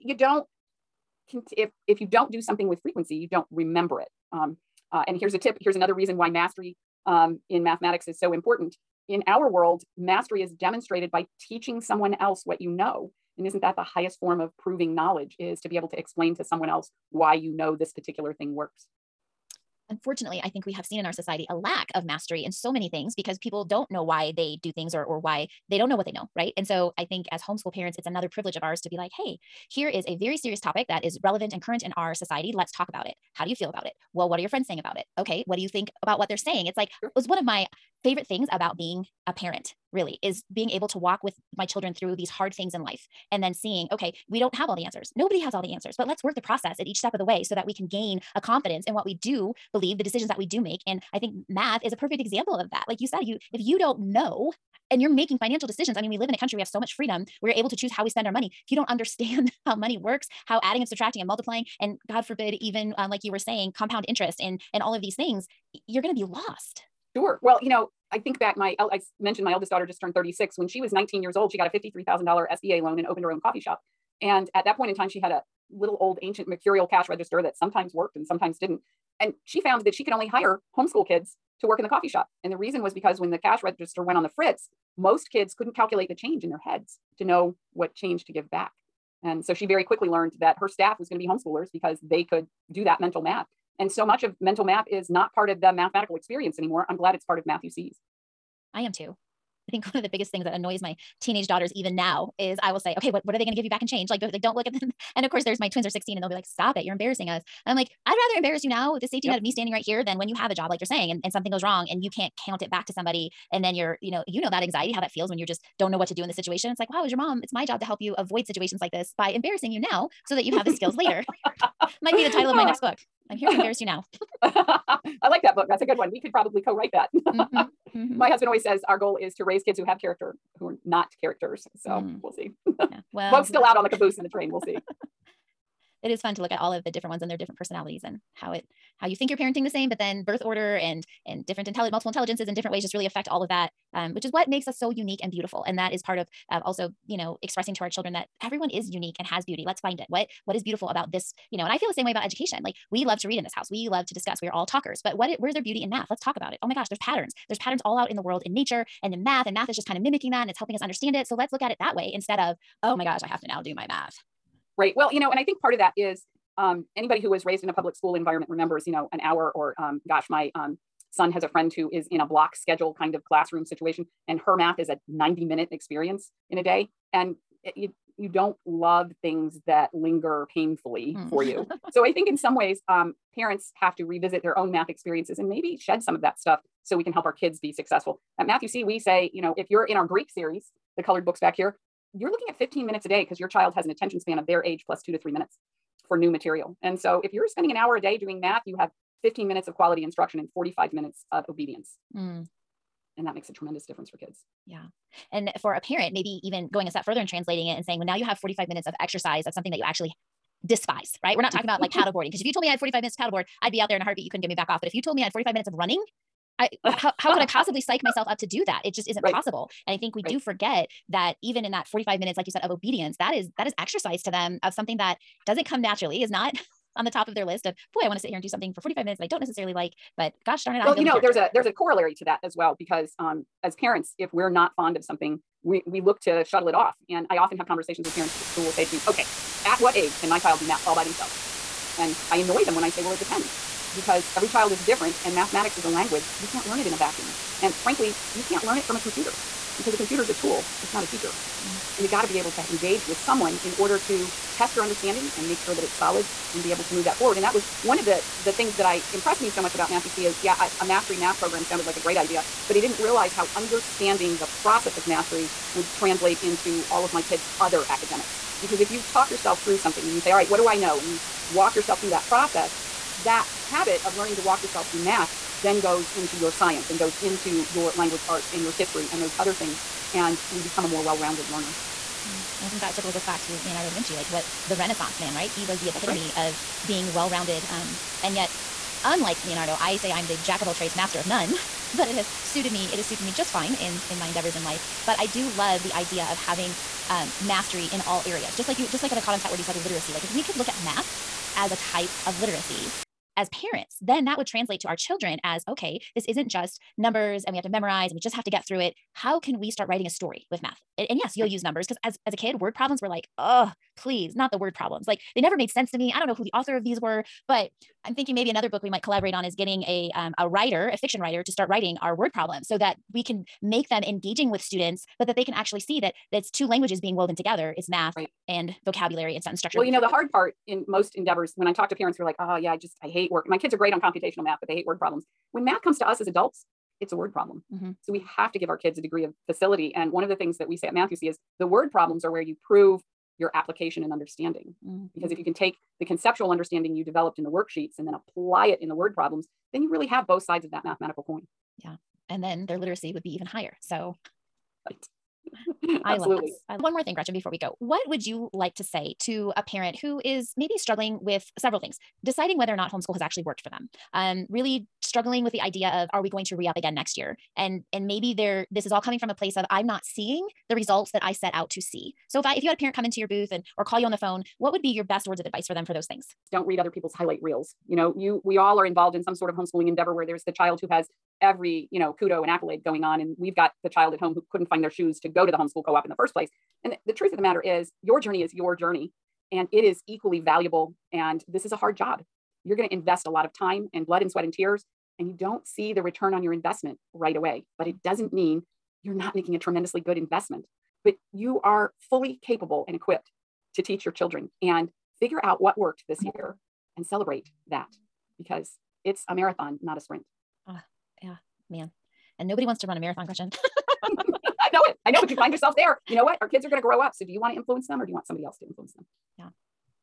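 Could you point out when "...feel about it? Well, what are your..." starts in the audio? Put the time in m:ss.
0:33.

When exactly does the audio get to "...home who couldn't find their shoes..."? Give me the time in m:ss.
6:24.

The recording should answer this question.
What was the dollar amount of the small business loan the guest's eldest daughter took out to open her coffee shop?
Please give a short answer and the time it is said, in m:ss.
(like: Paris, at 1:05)
$53,000, at 1:11.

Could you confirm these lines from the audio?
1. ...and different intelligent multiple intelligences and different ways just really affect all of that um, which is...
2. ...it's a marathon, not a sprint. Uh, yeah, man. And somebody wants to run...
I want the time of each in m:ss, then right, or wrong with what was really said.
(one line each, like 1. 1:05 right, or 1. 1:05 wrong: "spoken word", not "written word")
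1. 2:21 right
2. 6:49 wrong: "nobody", not "somebody".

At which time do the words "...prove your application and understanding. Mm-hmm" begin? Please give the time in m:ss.
5:42.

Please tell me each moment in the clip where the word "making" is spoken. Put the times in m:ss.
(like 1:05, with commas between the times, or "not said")
0:55, 6:39.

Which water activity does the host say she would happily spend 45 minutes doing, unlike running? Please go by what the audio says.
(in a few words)
paddleboarding.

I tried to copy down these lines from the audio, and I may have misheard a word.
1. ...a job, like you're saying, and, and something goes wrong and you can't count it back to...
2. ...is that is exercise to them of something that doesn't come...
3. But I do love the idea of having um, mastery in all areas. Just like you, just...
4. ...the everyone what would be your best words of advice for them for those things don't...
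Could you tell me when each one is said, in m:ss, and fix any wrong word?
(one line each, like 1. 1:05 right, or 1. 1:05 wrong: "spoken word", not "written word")
1. 1:50 right
2. 3:43 right
3. 4:55 right
4. 6:14 wrong: "phone", not "everyone".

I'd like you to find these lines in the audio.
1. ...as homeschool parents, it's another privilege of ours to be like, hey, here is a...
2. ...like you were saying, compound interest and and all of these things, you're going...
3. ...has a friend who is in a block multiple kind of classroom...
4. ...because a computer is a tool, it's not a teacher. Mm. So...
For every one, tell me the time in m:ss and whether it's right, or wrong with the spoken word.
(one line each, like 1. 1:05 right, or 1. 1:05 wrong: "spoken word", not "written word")
1. 0:27 right
2. 1:03 right
3. 2:51 wrong: "schedule", not "multiple"
4. 4:09 right.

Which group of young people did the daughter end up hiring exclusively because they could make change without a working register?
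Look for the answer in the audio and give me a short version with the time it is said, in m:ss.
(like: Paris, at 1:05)
homeschool kids, at 1:20.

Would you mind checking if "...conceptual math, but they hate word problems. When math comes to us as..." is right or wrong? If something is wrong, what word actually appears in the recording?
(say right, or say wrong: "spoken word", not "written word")
wrong: "computational", not "conceptual".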